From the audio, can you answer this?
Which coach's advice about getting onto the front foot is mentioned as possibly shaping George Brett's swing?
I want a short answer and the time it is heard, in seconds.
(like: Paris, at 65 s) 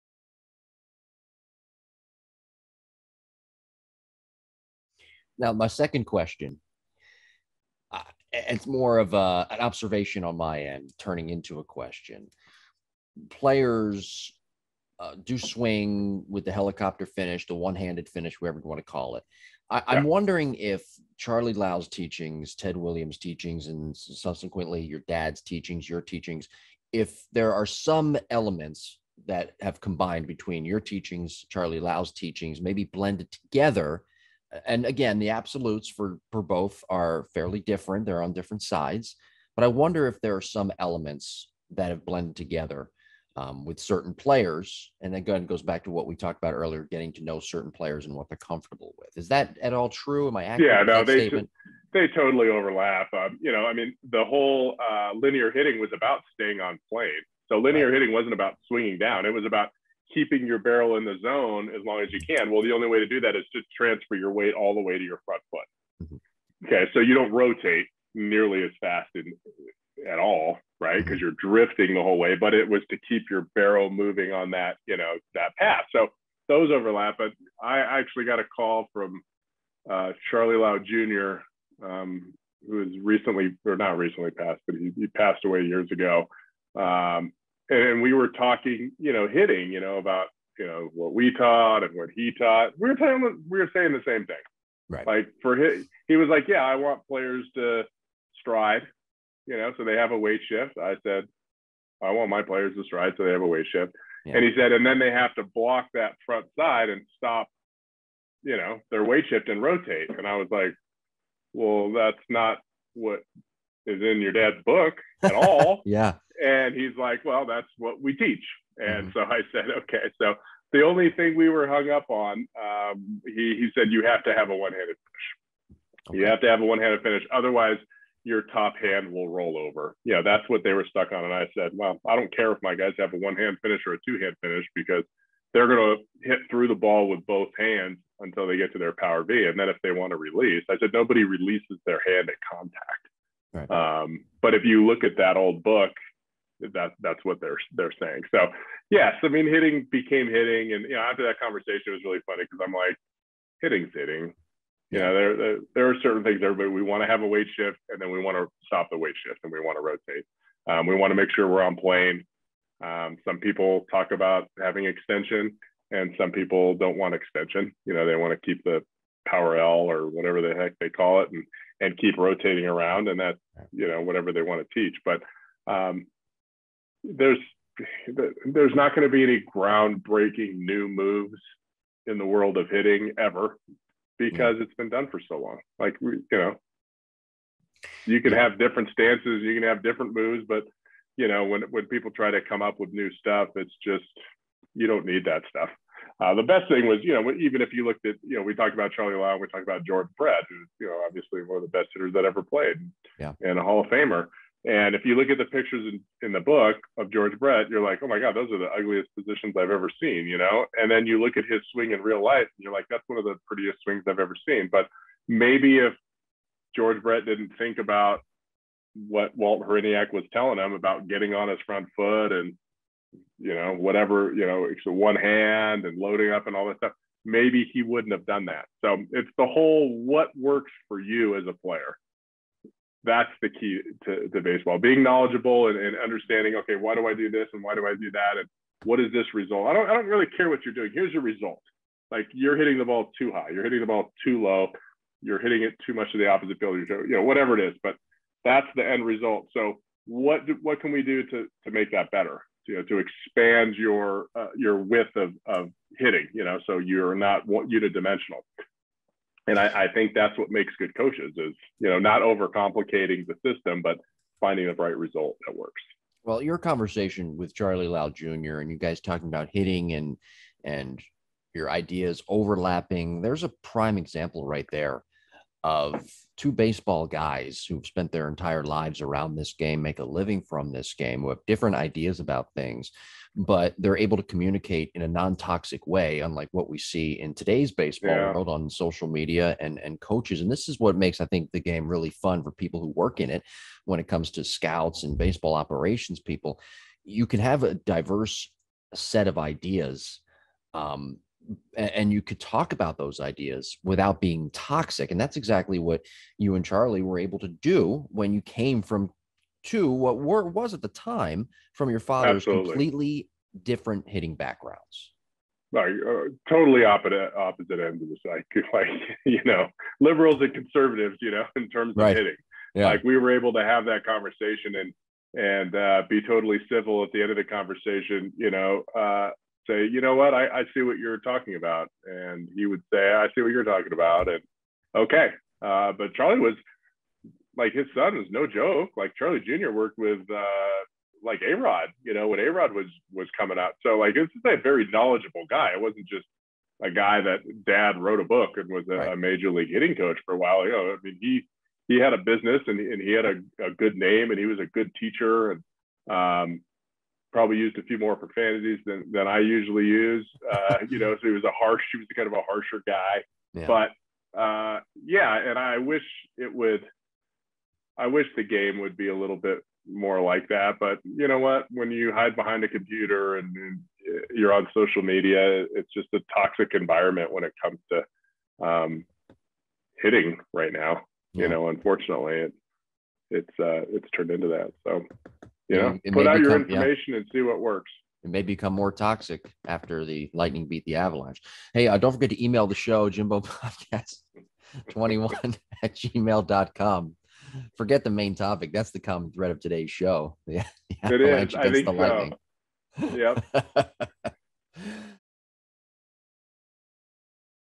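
Walt Hriniak, at 219 s.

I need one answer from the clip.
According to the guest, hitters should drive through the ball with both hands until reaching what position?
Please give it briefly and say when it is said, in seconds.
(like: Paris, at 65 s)
Power V, at 138 s.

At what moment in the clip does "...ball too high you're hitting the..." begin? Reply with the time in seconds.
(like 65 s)
242 s.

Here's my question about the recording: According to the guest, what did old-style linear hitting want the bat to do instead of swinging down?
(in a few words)
Staying on plane.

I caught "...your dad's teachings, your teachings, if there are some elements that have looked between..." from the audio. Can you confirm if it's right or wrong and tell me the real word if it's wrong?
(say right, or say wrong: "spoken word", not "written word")
wrong: "combined", not "looked".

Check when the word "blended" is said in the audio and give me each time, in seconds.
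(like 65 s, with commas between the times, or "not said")
32 s, 42 s.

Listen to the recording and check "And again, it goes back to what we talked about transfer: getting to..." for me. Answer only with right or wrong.
wrong.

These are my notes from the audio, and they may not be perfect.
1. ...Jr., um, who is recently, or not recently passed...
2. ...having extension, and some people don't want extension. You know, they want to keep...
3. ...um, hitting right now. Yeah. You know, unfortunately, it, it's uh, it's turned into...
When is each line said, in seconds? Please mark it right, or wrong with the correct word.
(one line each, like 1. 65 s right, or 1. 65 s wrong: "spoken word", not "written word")
1. 80 s right
2. 164 s right
3. 378 s right.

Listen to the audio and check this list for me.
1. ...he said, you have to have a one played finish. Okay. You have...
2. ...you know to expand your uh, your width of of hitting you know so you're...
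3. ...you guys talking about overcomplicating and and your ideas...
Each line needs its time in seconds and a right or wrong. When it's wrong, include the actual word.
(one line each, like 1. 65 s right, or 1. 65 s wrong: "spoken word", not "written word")
1. 123 s wrong: "handed", not "played"
2. 252 s right
3. 268 s wrong: "hitting", not "overcomplicating".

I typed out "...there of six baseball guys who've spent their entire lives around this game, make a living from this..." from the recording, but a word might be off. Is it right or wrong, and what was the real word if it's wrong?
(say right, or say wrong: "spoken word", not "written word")
wrong: "two", not "six".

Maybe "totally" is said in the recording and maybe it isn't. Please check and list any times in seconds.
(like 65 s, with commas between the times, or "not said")
52 s, 316 s, 326 s.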